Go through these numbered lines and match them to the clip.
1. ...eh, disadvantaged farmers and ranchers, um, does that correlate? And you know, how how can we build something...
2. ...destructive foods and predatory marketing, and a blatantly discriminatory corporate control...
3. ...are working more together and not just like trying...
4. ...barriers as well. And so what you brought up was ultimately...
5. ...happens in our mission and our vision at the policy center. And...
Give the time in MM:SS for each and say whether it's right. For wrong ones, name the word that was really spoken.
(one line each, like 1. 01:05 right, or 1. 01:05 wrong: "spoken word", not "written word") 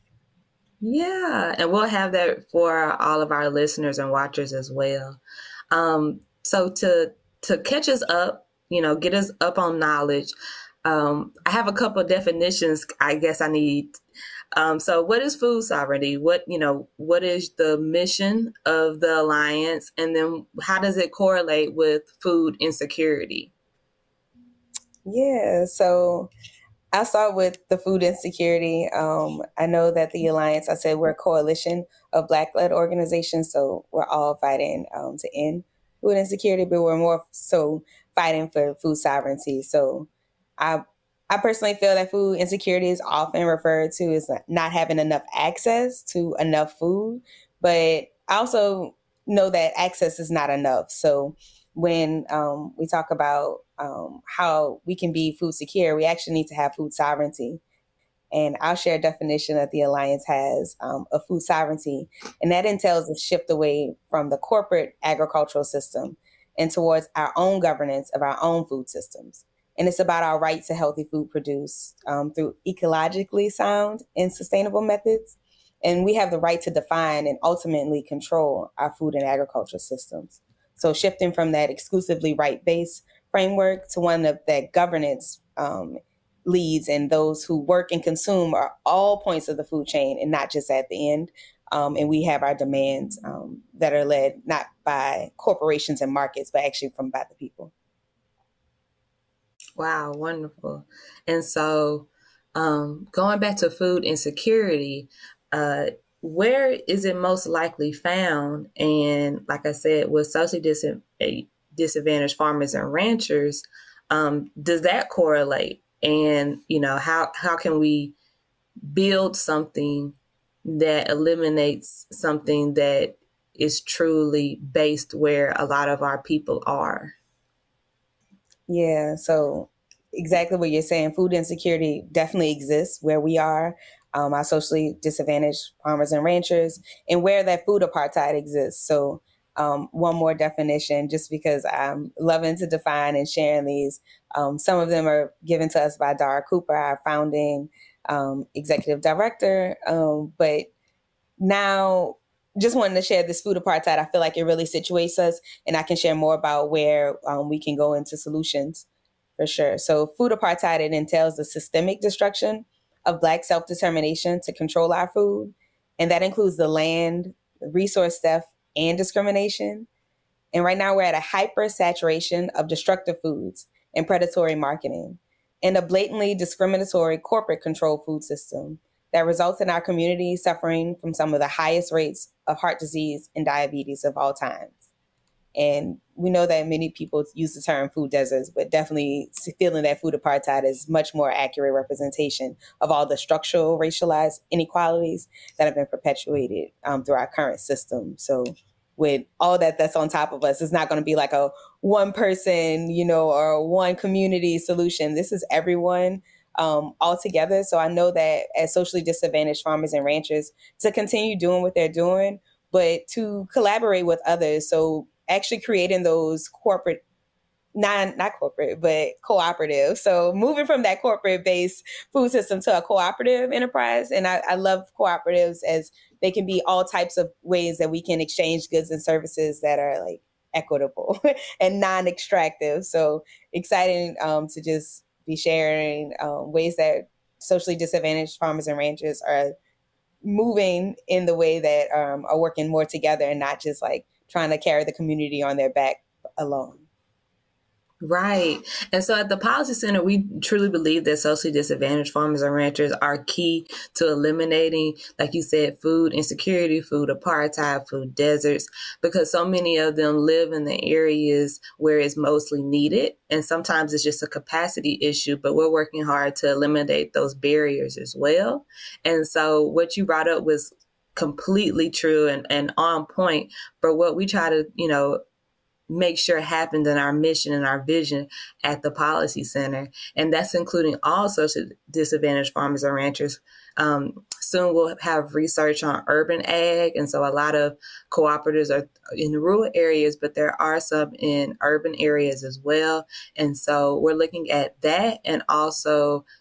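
1. 01:51 right
2. 02:52 right
3. 04:02 right
4. 04:27 wrong: "completely", not "ultimately"
5. 04:36 right.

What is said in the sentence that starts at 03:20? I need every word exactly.
It's not going to be like a one person, you know, or one community solution.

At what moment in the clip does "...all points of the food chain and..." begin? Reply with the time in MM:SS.
01:28.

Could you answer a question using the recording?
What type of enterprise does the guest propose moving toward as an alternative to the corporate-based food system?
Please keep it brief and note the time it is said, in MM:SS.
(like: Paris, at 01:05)
cooperative enterprise, at 03:42.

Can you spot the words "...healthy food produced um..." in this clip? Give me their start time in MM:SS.
01:10.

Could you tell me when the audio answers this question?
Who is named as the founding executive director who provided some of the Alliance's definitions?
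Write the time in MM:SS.
02:26.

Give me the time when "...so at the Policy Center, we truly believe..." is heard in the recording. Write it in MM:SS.
04:09.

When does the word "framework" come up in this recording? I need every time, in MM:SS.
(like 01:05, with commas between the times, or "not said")
01:23.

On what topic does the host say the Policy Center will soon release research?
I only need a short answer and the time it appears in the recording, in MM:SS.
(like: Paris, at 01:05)
urban ag, at 04:46.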